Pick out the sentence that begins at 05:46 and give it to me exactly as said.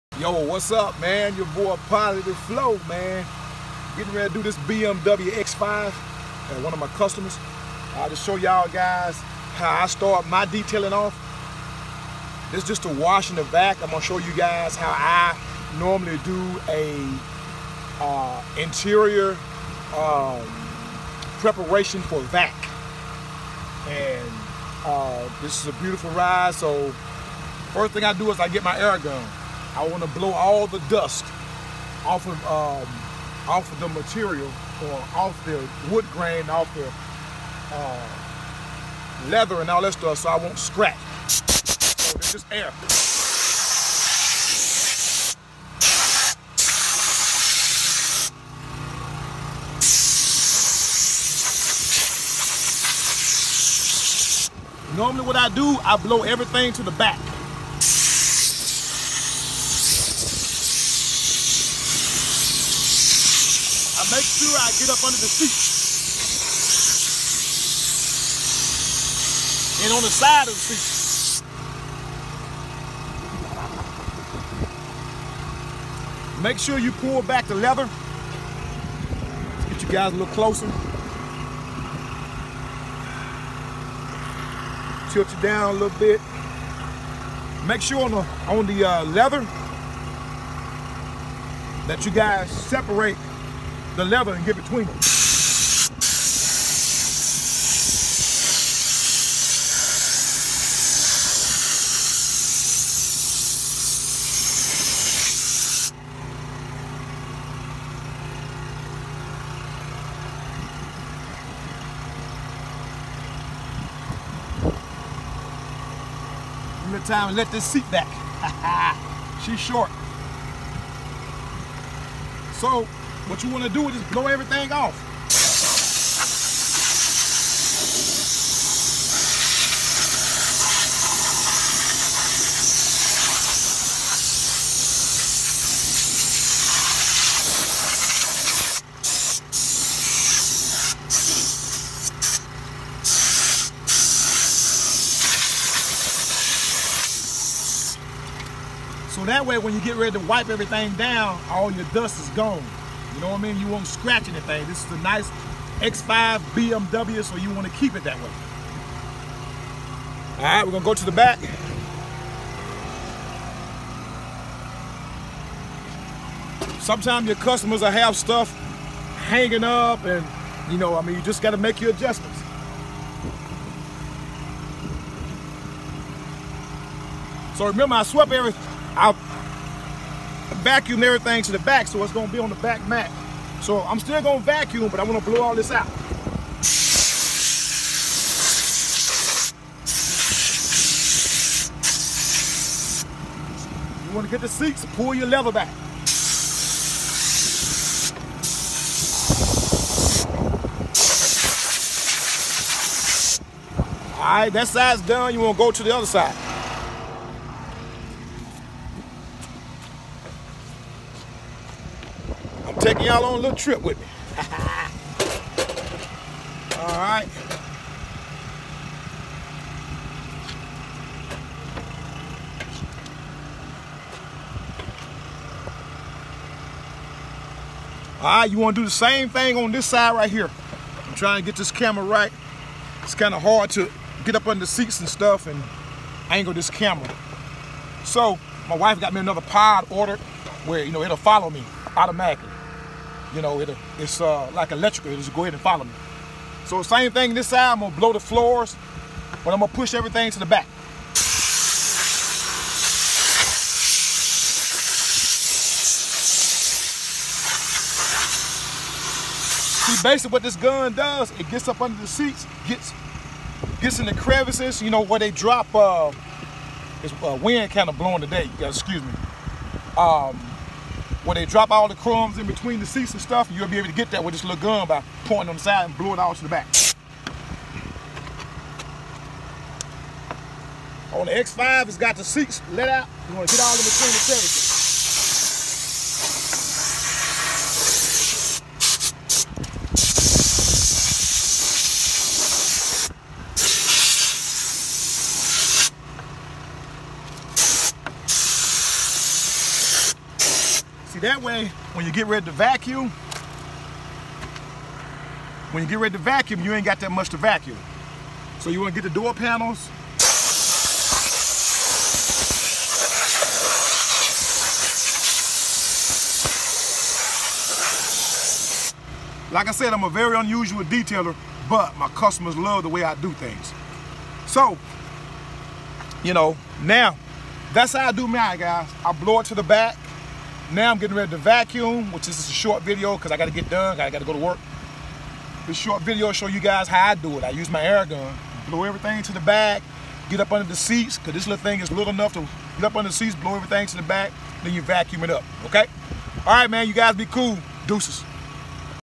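All right, man, you guys be cool.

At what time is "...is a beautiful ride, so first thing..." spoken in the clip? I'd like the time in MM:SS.
00:25.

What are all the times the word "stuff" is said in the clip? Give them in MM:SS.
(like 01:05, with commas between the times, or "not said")
00:39, 02:48, 03:55, 04:33.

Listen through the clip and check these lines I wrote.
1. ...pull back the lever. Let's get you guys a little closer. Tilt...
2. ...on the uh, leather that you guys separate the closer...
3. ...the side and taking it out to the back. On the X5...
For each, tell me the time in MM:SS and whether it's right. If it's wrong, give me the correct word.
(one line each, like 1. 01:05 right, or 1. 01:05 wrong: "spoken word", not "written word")
1. 01:16 right
2. 01:28 wrong: "leather", not "closer"
3. 04:35 wrong: "blowing", not "taking".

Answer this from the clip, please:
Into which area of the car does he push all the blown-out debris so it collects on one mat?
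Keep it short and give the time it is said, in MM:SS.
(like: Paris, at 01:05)
the back mat, at 03:02.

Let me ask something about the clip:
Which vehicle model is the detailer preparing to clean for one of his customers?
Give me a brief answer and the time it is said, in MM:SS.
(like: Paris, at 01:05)
BMW X5, at 00:04.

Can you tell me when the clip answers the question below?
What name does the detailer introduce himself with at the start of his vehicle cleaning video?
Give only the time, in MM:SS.
00:01.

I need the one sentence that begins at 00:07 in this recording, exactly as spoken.
I'll just show y'all guys how I start my detailing off.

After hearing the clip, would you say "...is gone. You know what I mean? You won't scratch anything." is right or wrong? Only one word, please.
right.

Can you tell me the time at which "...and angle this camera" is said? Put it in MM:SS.
03:55.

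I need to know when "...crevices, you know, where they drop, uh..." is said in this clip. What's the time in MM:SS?
04:24.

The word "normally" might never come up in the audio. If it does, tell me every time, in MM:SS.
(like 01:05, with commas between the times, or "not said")
00:15, 00:54.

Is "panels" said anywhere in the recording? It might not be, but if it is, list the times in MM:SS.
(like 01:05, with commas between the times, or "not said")
05:09.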